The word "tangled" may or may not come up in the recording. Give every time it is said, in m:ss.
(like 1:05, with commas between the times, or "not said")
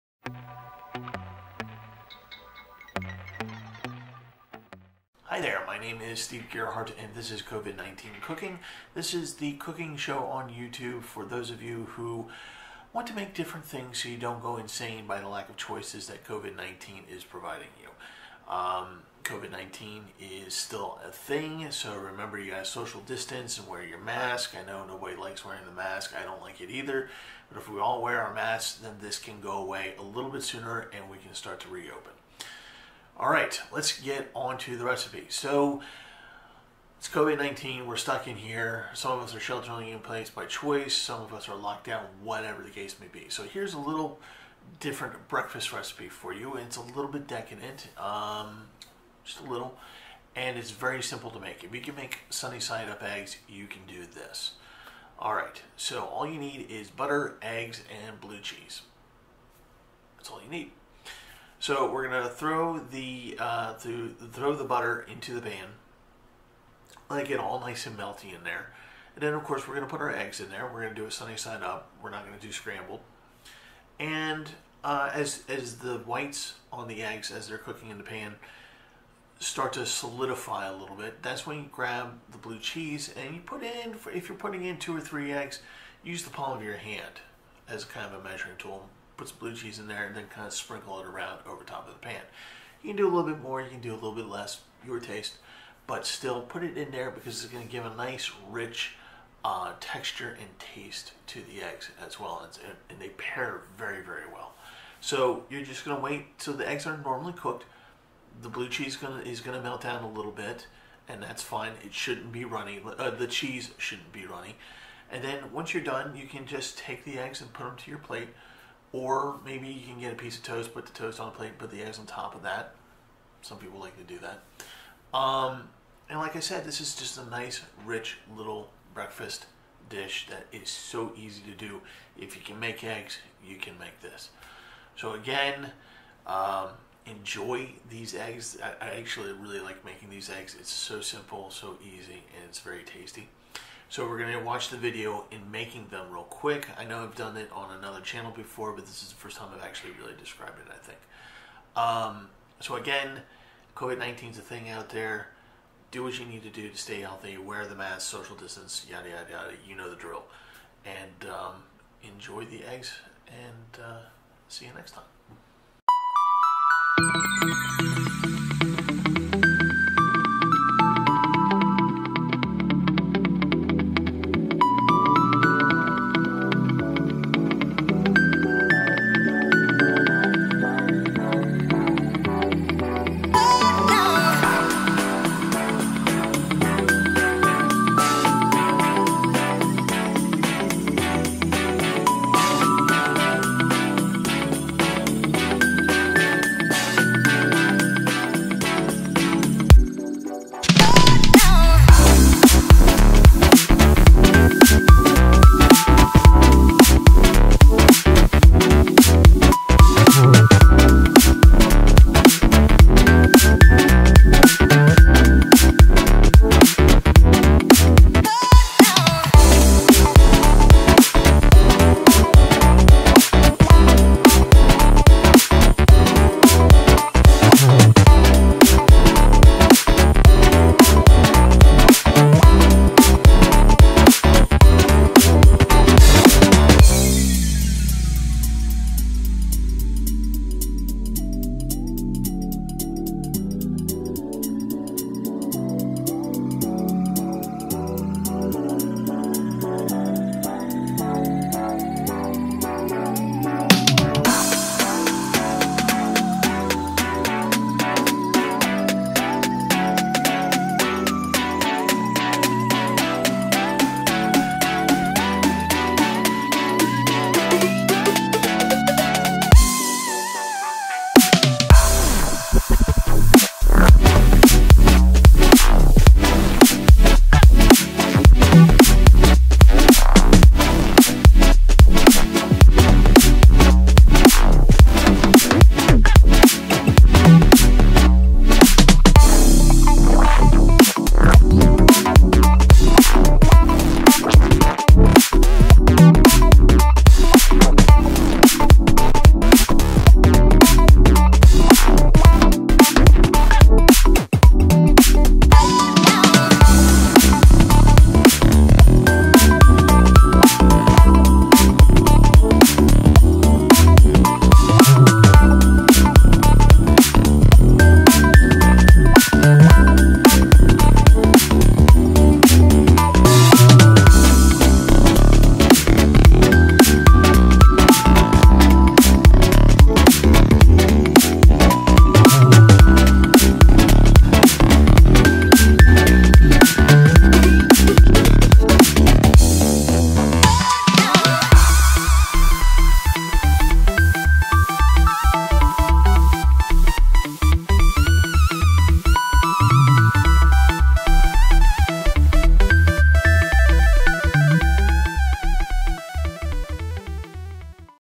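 not said.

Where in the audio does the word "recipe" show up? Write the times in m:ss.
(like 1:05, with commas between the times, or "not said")
0:34, 0:45.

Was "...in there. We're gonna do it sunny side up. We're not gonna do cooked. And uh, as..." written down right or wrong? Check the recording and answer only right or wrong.
wrong.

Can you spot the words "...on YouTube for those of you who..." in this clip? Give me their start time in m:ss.
0:10.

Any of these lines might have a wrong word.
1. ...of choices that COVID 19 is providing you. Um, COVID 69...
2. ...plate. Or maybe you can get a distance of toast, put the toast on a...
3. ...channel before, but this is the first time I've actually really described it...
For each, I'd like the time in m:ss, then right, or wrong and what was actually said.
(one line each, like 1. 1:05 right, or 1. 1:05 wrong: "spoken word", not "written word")
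1. 0:15 wrong: "19", not "69"
2. 1:57 wrong: "piece", not "distance"
3. 2:27 right.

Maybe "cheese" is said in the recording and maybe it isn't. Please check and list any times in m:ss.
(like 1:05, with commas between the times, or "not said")
0:58, 1:22, 1:29, 1:48, 1:53.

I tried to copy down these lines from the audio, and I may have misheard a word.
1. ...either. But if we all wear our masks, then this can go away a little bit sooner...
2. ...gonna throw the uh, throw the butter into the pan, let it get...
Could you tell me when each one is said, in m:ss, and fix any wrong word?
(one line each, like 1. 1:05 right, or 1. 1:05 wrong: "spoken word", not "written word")
1. 0:26 right
2. 1:02 right.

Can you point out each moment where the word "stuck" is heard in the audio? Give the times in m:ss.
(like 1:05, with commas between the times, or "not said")
0:37.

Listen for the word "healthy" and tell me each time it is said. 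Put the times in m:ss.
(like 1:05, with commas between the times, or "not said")
2:37.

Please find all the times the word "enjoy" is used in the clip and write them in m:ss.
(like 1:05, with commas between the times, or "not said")
2:17, 2:42.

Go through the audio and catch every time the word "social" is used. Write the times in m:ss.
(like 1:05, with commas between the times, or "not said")
0:22, 2:38.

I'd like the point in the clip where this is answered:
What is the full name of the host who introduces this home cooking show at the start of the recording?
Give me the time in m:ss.
0:06.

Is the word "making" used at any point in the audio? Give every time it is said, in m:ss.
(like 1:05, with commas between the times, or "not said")
2:19, 2:25.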